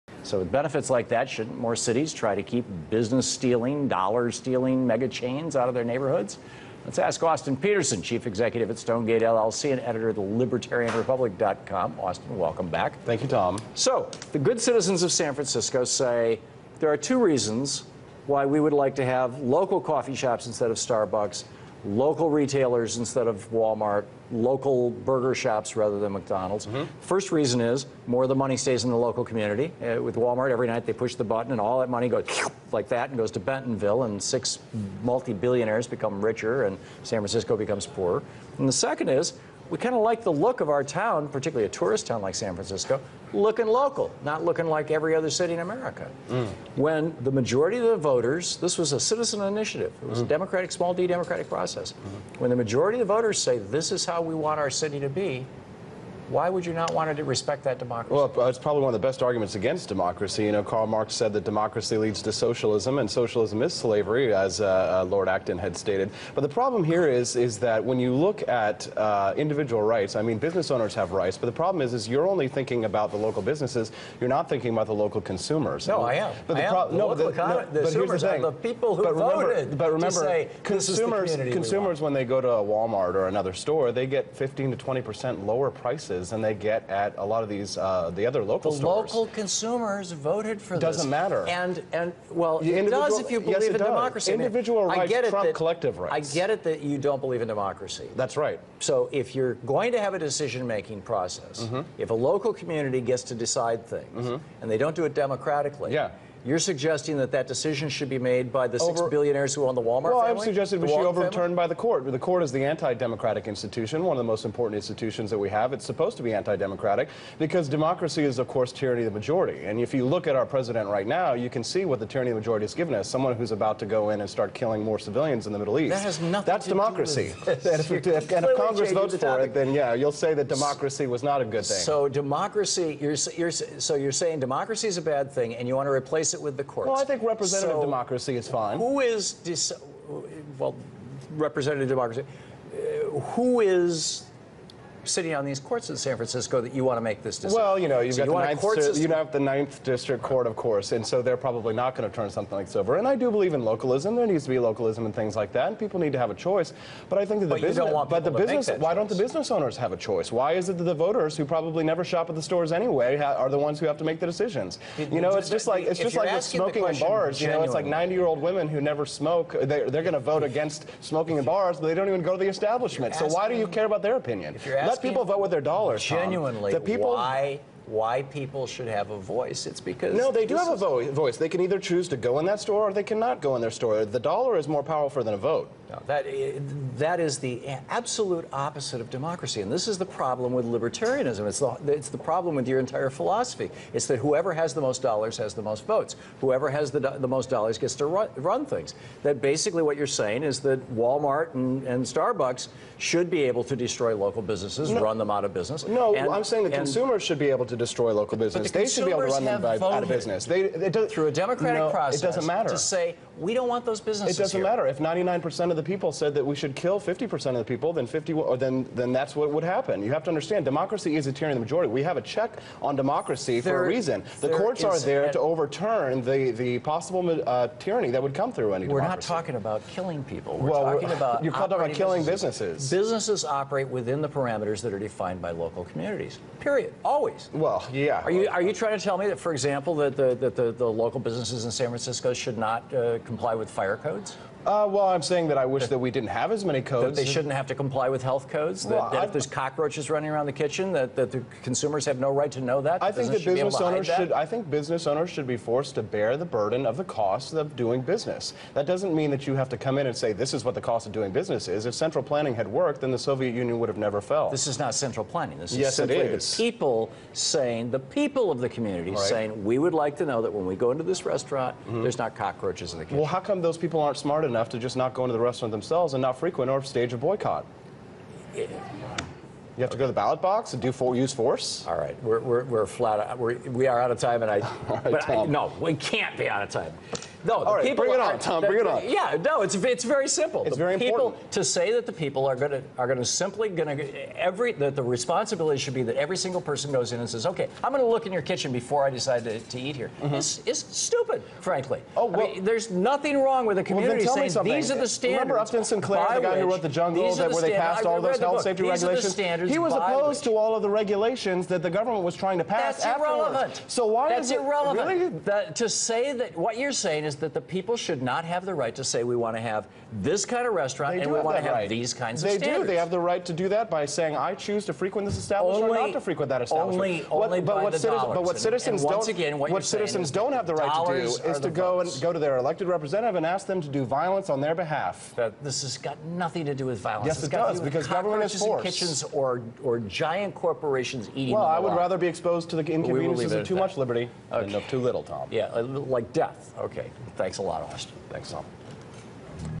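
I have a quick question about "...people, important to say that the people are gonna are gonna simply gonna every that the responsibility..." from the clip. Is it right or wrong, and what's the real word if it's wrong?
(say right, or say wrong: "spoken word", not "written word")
right.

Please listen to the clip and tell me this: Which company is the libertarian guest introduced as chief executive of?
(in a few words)
Stonegait LLC.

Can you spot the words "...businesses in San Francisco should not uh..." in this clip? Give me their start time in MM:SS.
04:01.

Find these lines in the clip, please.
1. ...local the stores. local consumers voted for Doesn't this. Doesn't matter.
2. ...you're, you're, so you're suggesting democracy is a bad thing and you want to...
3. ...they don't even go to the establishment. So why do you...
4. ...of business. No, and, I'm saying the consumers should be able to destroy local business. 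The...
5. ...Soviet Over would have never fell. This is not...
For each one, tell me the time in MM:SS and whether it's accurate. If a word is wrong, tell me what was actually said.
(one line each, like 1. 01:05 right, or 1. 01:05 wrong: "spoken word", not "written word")
1. 01:28 right
2. 02:12 wrong: "saying", not "suggesting"
3. 02:51 right
4. 03:25 right
5. 04:23 wrong: "Union", not "Over".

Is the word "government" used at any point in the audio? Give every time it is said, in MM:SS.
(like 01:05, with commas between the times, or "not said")
05:11, 05:38.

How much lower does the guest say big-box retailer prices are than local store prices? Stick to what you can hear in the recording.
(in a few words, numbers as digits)
15 to 20 percent.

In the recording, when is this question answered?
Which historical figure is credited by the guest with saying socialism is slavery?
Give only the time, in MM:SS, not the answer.
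01:05.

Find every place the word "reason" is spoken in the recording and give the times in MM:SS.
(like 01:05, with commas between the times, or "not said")
00:17, 00:27, 03:43.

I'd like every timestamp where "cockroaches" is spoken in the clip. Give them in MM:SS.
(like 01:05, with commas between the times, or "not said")
04:09, 04:32.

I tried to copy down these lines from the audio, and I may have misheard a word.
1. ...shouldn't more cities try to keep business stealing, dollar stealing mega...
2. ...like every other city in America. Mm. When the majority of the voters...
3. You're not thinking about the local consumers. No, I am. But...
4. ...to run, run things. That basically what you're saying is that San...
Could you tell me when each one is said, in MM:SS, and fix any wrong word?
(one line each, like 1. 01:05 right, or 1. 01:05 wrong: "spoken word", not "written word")
1. 00:01 right
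2. 00:44 right
3. 01:14 right
4. 03:17 wrong: "Walmart", not "San".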